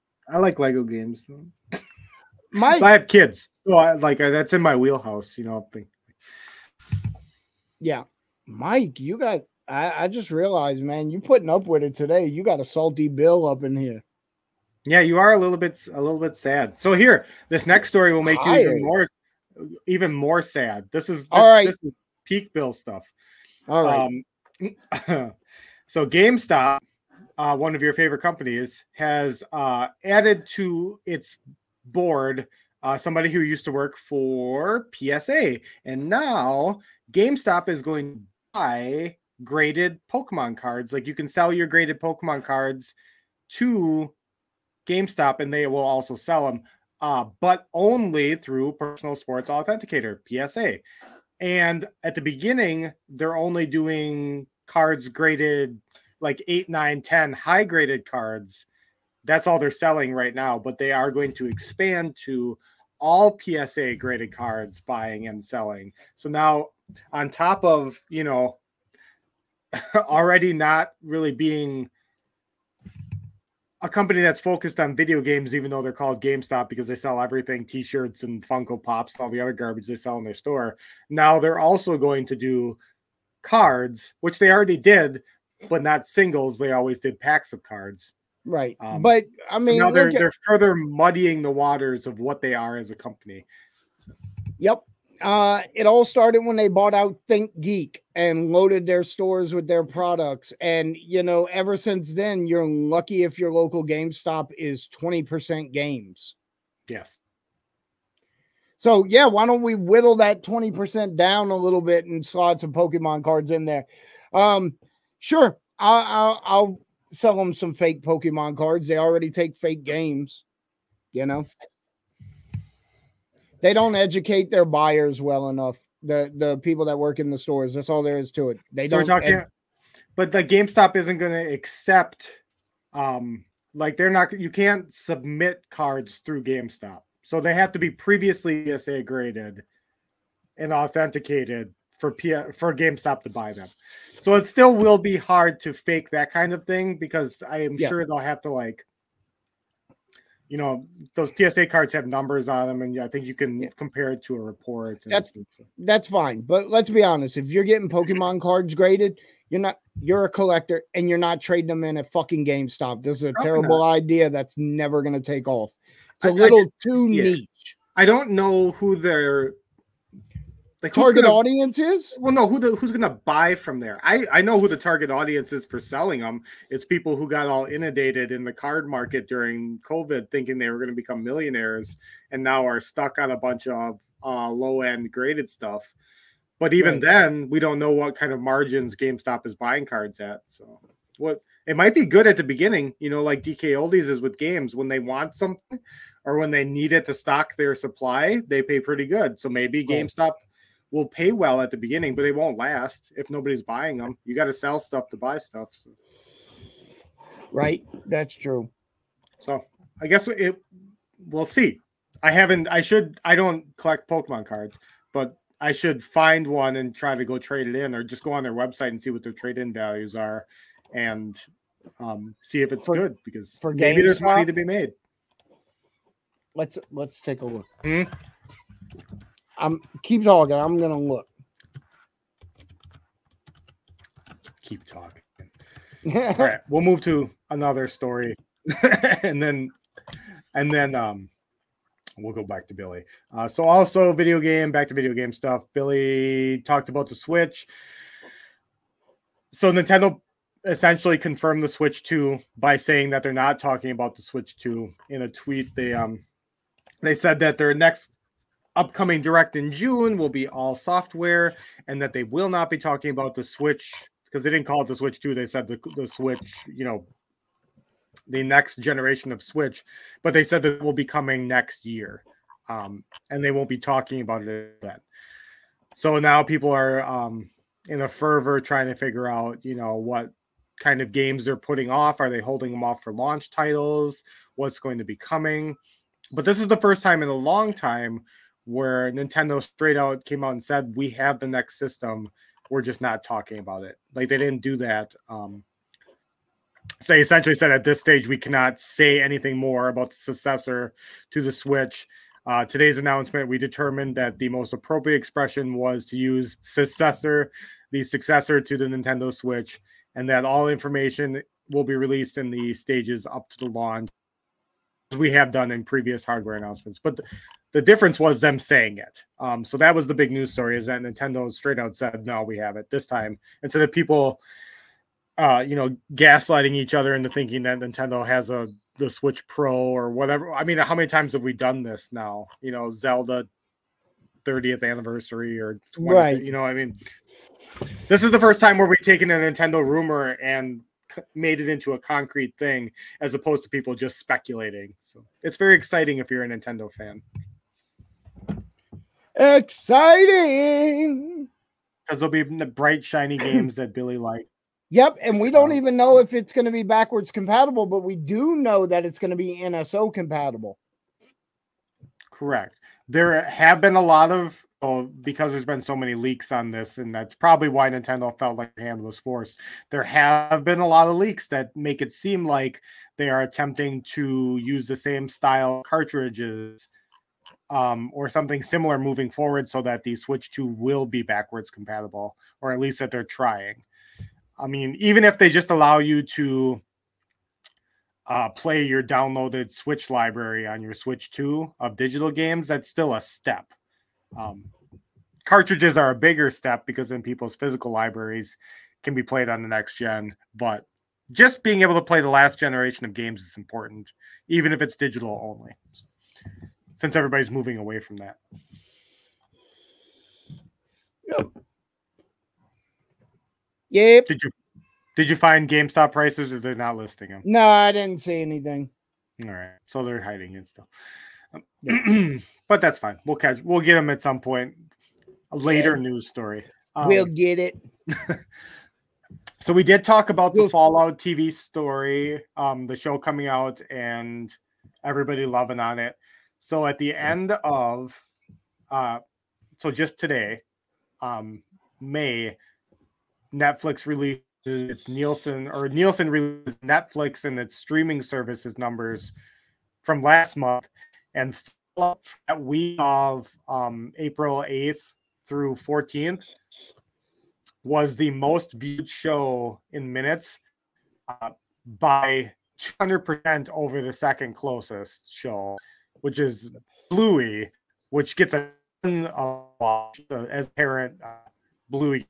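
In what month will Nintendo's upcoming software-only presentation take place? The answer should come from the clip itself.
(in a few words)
June.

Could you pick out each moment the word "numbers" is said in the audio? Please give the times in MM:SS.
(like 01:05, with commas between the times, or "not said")
02:32, 07:28.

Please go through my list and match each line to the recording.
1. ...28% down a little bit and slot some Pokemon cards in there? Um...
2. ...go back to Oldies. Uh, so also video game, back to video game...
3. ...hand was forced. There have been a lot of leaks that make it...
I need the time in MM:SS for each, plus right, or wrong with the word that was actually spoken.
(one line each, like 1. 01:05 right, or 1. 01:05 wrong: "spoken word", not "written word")
1. 01:50 wrong: "20", not "28"
2. 04:02 wrong: "Billy", not "Oldies"
3. 06:08 right.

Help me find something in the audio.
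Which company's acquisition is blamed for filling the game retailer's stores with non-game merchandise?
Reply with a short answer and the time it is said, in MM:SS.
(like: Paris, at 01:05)
Think Geek, at 01:37.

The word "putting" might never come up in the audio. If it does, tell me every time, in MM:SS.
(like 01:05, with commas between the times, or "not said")
00:11, 04:41.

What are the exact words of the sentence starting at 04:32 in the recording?
Um, and they won't be talking about it then.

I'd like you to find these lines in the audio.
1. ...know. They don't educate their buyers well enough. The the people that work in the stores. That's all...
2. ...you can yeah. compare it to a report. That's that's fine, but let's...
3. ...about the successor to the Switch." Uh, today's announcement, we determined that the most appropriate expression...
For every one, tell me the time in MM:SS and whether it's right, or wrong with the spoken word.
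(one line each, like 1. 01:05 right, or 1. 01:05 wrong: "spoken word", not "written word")
1. 02:01 right
2. 02:33 right
3. 04:59 right.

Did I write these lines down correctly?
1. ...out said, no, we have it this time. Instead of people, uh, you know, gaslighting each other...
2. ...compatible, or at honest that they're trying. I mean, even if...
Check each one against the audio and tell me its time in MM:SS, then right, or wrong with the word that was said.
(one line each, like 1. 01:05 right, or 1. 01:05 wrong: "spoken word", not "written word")
1. 05:21 right
2. 06:21 wrong: "least", not "honest".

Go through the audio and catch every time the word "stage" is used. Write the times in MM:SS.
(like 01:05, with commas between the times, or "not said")
04:57, 05:12.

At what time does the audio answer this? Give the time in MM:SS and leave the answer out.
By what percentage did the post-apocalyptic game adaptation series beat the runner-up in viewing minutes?
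07:42.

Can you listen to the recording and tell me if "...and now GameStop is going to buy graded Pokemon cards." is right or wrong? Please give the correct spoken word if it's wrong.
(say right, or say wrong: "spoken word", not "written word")
right.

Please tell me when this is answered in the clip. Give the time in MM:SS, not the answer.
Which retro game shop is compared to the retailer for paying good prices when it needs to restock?
03:13.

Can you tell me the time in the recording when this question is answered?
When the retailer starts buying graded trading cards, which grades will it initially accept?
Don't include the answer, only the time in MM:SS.
00:56.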